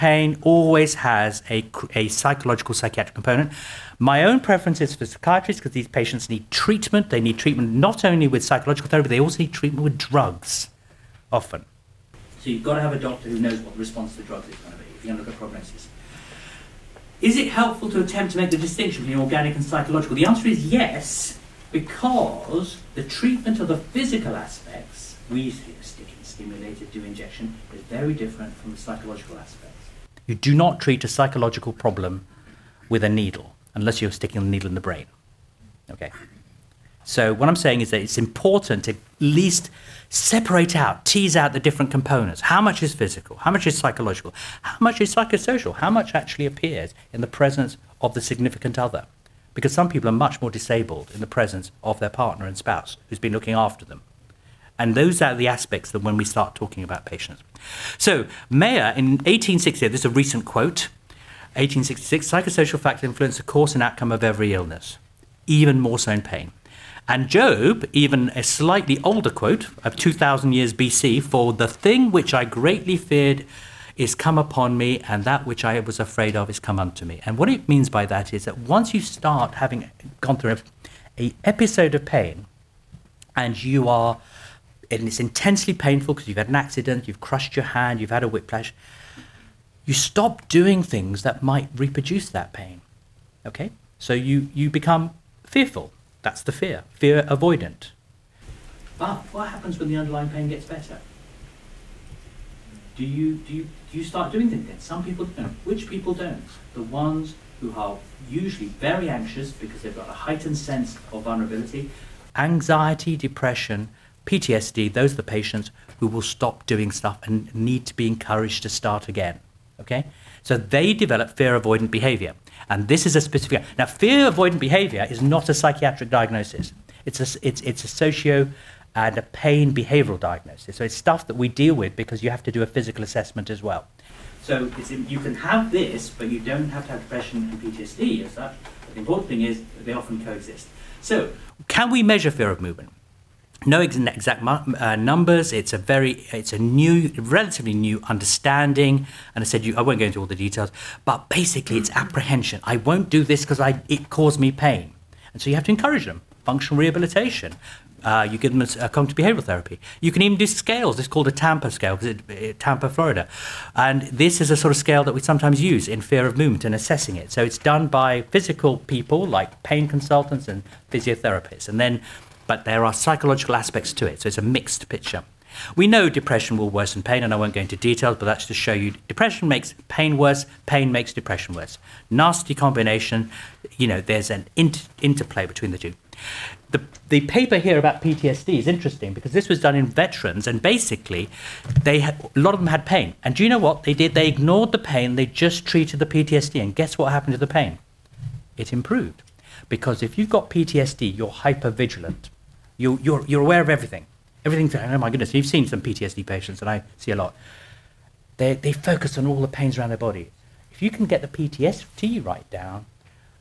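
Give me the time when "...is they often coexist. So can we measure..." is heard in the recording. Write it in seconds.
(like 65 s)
139 s.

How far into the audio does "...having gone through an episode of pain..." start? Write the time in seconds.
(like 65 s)
79 s.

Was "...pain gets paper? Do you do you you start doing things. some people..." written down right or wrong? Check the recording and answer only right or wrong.
wrong.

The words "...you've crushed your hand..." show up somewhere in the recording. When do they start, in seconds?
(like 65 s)
87 s.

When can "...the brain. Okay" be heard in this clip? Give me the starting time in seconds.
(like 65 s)
34 s.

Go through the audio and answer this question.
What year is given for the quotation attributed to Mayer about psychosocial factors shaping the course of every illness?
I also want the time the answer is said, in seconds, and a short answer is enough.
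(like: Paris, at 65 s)
1866, at 61 s.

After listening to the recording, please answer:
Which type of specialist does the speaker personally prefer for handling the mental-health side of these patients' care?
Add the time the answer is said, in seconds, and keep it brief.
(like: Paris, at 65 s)
Psychiatrists, at 5 s.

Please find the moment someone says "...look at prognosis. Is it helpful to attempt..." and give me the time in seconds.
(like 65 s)
15 s.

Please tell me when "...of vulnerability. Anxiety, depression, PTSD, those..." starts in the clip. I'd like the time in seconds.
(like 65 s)
111 s.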